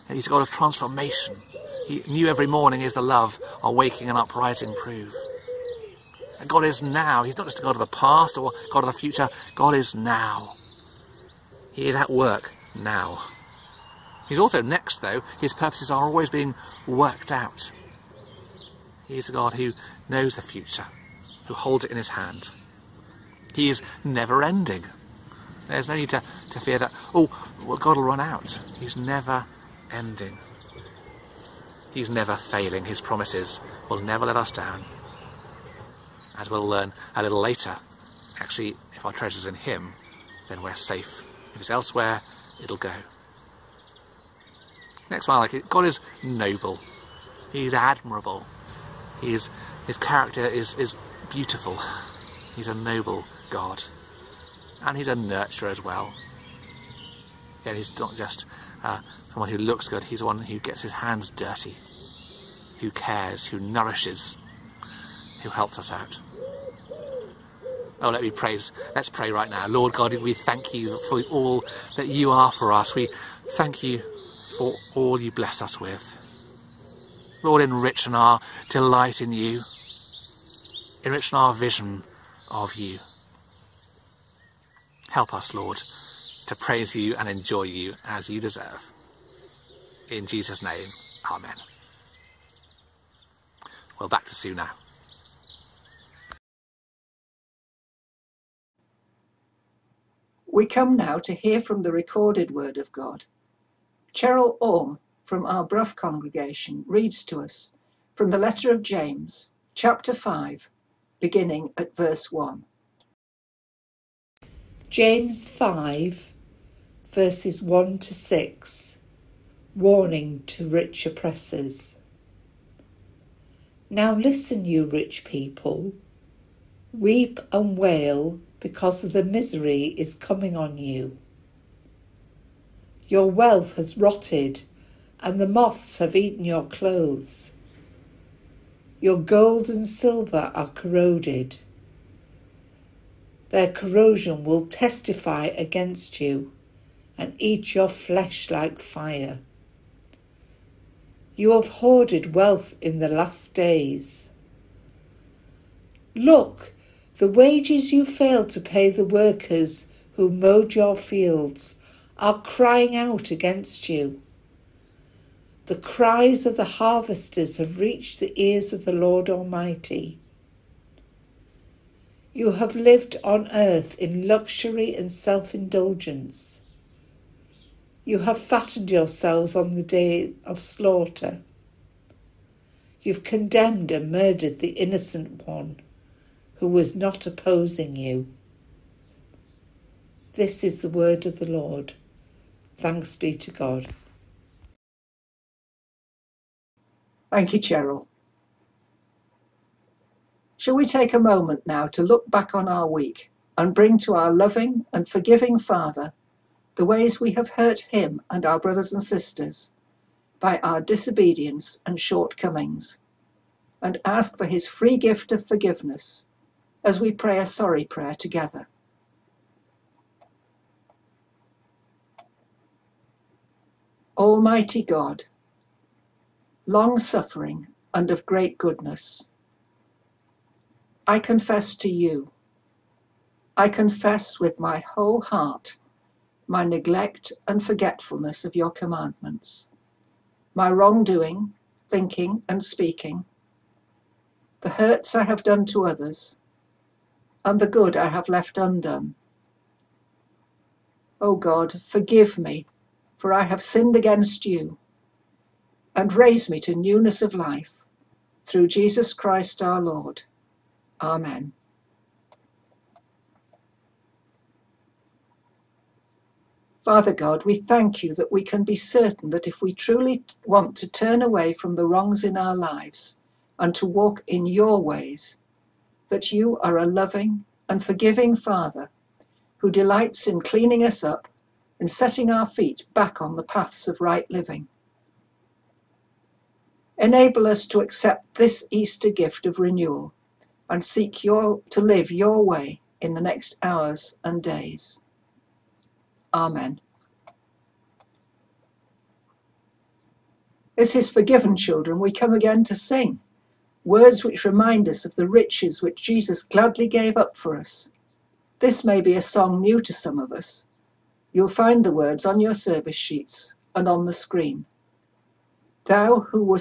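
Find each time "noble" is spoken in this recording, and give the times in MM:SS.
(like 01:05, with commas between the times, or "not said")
00:46, 00:52.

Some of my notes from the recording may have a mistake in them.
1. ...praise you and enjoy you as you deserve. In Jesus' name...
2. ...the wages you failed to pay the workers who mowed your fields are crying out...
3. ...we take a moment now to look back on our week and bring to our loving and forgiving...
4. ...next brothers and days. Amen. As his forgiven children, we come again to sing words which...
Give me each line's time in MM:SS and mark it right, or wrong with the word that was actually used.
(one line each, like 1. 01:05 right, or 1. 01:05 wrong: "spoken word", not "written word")
1. 01:26 right
2. 02:37 right
3. 03:20 right
4. 04:53 wrong: "hours", not "brothers".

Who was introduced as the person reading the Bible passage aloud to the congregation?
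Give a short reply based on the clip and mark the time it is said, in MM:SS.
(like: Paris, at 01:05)
Cheryl Orme, at 01:44.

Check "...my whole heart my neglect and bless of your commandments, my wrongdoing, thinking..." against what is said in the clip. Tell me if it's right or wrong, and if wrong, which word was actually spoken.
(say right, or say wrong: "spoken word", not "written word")
wrong: "forgetfulness", not "bless".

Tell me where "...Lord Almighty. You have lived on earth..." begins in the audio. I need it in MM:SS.
02:48.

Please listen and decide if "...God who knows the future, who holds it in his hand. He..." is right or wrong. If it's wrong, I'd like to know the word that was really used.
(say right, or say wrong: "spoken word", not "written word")
right.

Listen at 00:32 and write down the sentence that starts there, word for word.
His promises will never let us down.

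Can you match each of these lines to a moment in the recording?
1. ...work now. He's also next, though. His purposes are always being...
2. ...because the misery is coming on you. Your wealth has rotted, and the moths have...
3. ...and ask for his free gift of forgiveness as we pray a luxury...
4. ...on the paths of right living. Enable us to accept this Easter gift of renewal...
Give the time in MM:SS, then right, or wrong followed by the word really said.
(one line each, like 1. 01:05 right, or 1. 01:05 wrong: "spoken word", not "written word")
1. 00:12 right
2. 02:08 right
3. 03:33 wrong: "sorry", not "luxury"
4. 04:43 right.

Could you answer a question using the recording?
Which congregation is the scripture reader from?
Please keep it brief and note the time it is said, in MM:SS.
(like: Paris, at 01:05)
Brough, at 01:45.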